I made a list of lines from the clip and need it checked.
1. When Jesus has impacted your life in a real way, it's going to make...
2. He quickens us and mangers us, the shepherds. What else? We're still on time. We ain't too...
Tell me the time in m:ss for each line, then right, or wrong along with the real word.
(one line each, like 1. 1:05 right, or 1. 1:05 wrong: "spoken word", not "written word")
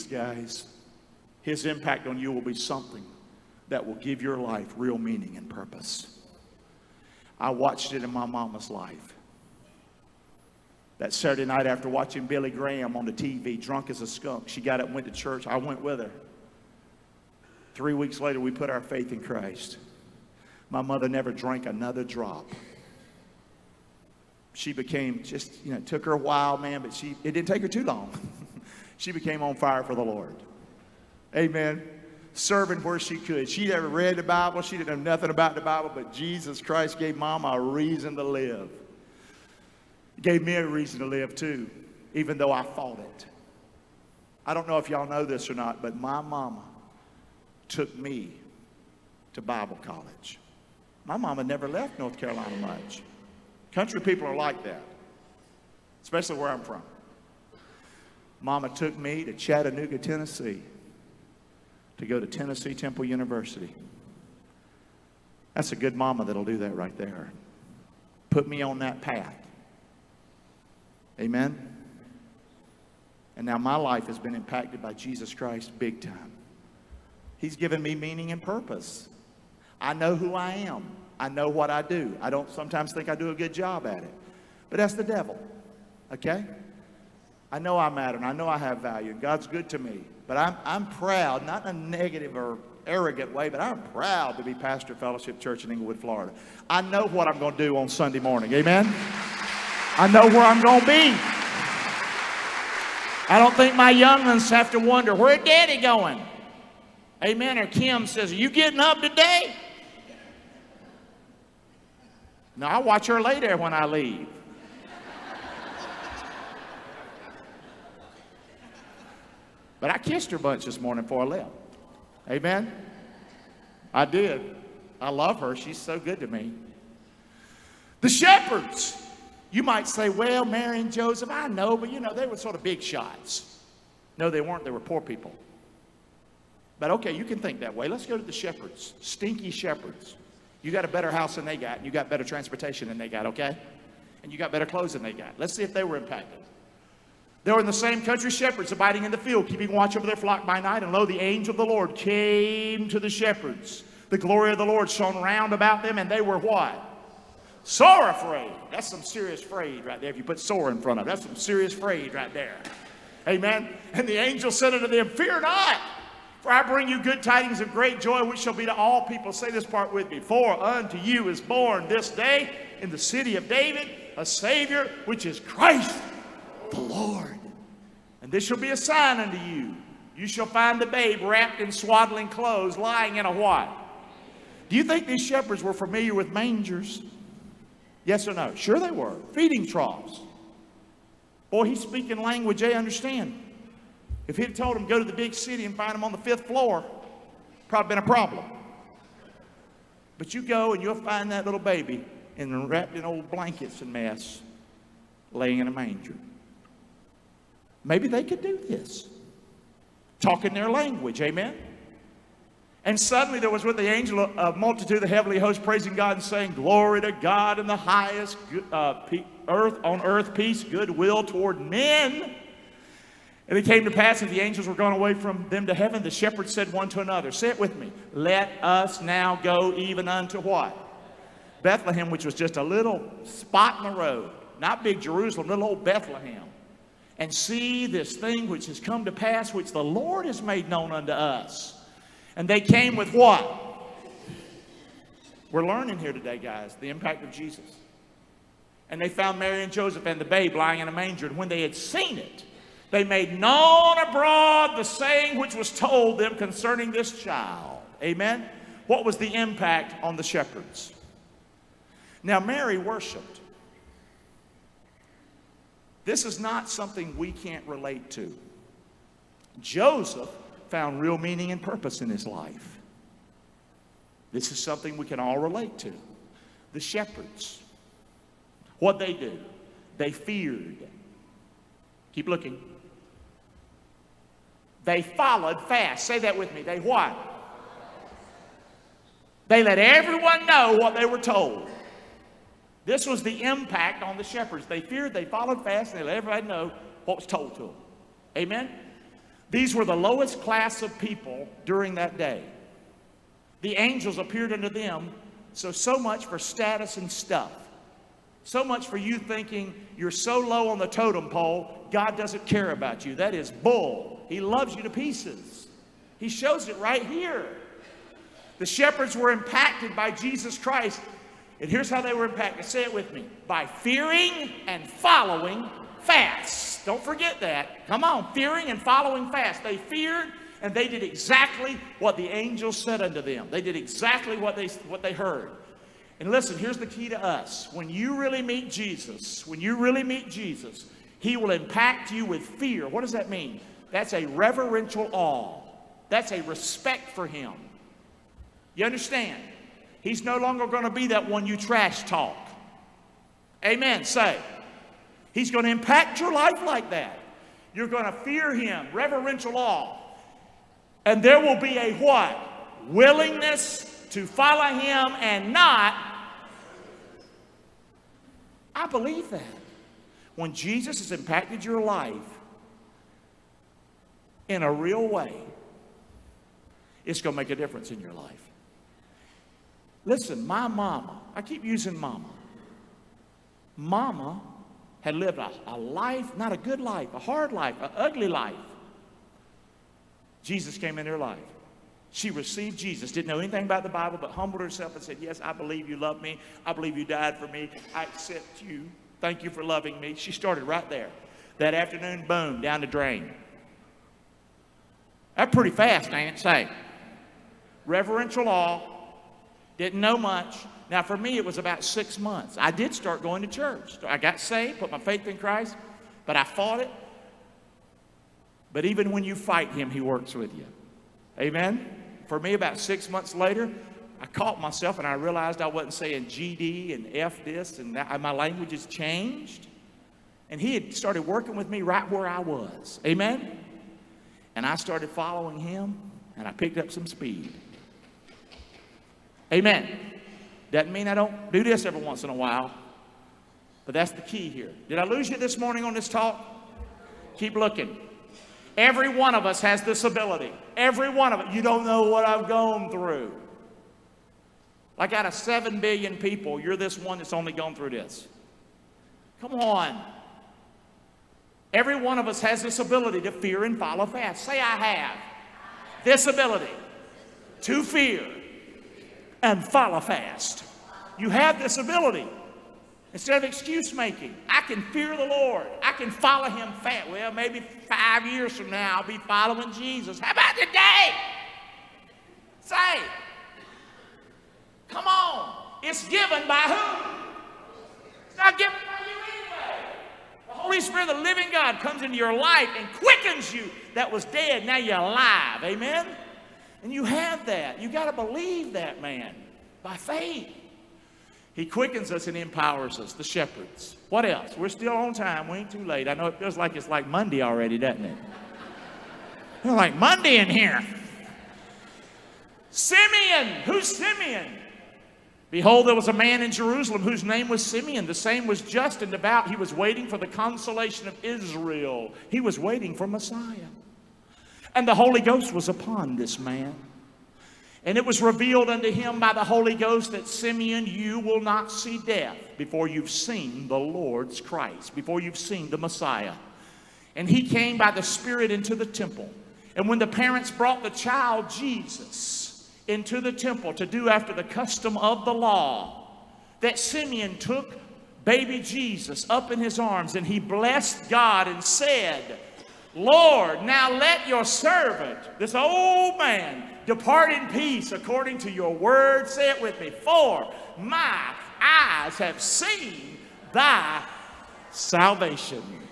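1. 6:10 right
2. 8:21 wrong: "empowers", not "mangers".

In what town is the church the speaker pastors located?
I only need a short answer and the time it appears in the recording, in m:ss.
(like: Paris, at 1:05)
Englewood, Florida, at 1:35.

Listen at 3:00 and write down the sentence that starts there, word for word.
You shall find the babe wrapped in swaddling clothes, lying in a what?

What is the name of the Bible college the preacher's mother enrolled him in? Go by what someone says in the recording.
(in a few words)
Tennessee Temple University.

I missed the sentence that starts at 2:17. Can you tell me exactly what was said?
Let's go to the shepherds, stinky shepherds.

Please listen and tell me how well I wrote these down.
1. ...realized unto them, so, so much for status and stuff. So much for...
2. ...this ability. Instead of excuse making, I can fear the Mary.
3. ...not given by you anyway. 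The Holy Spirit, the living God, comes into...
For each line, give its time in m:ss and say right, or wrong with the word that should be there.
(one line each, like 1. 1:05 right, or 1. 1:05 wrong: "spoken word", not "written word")
1. 5:04 wrong: "appeared", not "realized"
2. 7:51 wrong: "Lord", not "Mary"
3. 8:08 right.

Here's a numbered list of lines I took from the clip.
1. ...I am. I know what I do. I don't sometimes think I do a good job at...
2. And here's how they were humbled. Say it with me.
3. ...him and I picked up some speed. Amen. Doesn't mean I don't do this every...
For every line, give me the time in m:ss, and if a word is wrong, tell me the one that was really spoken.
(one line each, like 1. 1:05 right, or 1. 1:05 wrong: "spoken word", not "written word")
1. 1:20 right
2. 5:21 wrong: "impacted", not "humbled"
3. 7:15 right.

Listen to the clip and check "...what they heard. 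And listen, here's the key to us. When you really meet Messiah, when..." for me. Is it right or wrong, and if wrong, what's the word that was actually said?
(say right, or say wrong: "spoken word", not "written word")
wrong: "Jesus", not "Messiah".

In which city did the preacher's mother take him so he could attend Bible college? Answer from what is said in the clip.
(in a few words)
Chattanooga, Tennessee.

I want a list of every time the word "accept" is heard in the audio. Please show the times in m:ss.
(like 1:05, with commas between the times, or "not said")
6:38.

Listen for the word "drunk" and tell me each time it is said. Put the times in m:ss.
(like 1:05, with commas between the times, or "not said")
0:13.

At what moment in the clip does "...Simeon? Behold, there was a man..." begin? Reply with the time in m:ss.
8:33.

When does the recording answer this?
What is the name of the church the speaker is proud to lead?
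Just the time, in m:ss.
1:34.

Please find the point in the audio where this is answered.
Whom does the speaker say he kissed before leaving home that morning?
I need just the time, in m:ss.
1:47.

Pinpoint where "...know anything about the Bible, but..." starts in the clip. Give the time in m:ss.
6:33.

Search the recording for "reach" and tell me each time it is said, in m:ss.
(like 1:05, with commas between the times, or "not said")
not said.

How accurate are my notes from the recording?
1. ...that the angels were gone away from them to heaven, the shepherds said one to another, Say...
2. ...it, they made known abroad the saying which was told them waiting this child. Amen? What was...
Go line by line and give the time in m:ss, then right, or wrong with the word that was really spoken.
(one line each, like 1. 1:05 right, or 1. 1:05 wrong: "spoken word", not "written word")
1. 3:44 right
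2. 4:12 wrong: "concerning", not "waiting".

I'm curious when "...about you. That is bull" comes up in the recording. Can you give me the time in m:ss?
5:12.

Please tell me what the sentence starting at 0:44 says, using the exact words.
I don't know if y'all know this or not, but my mama took me to Bible college.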